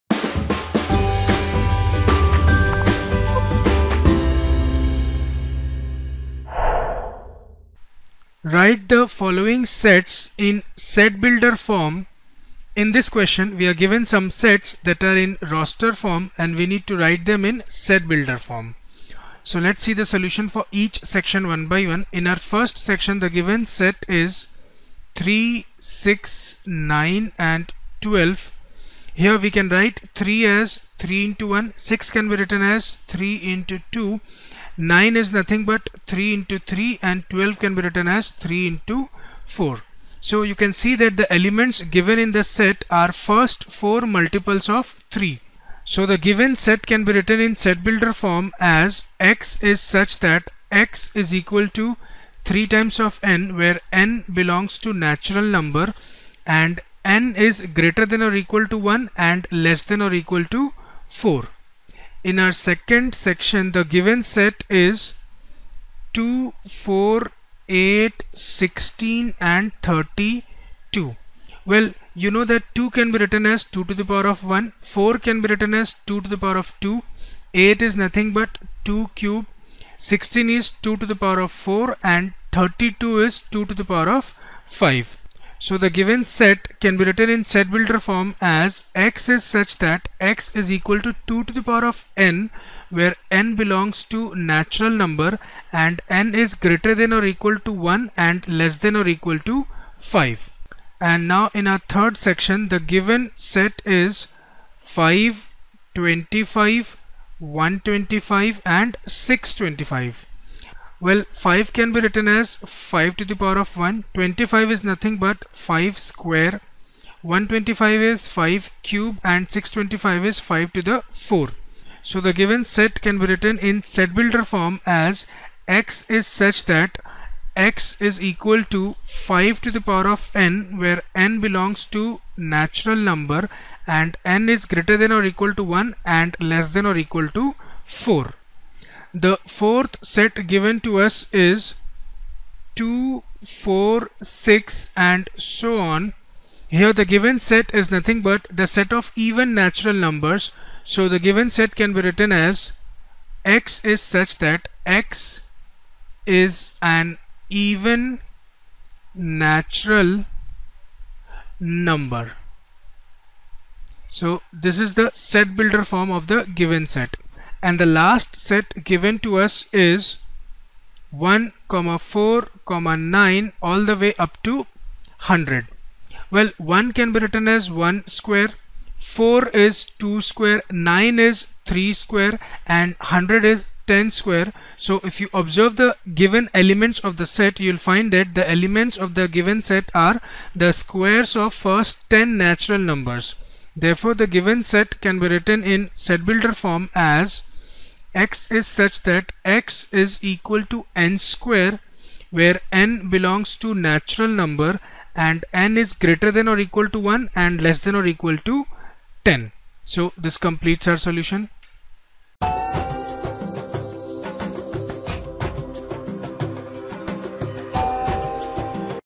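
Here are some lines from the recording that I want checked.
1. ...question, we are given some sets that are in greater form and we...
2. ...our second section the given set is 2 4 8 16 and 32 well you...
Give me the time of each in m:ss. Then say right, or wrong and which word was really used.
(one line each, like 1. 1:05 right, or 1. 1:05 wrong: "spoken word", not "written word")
1. 0:13 wrong: "roster", not "greater"
2. 1:02 right.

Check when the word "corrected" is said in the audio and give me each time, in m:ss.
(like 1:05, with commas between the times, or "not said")
not said.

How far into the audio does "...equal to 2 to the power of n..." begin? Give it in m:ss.
1:30.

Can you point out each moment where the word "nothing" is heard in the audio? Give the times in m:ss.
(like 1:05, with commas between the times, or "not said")
0:35, 1:17, 1:54, 2:27.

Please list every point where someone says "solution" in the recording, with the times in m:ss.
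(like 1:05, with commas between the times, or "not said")
0:20, 3:30.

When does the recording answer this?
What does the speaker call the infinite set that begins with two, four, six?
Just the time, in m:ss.
2:29.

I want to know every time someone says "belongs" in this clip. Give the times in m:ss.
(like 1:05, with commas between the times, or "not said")
0:54, 1:33, 2:11, 3:23.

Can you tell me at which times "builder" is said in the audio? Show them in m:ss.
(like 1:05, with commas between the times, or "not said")
0:11, 0:18, 0:47, 1:27, 2:04, 2:45, 3:16.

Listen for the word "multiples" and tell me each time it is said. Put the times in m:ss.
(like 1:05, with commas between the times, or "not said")
0:44.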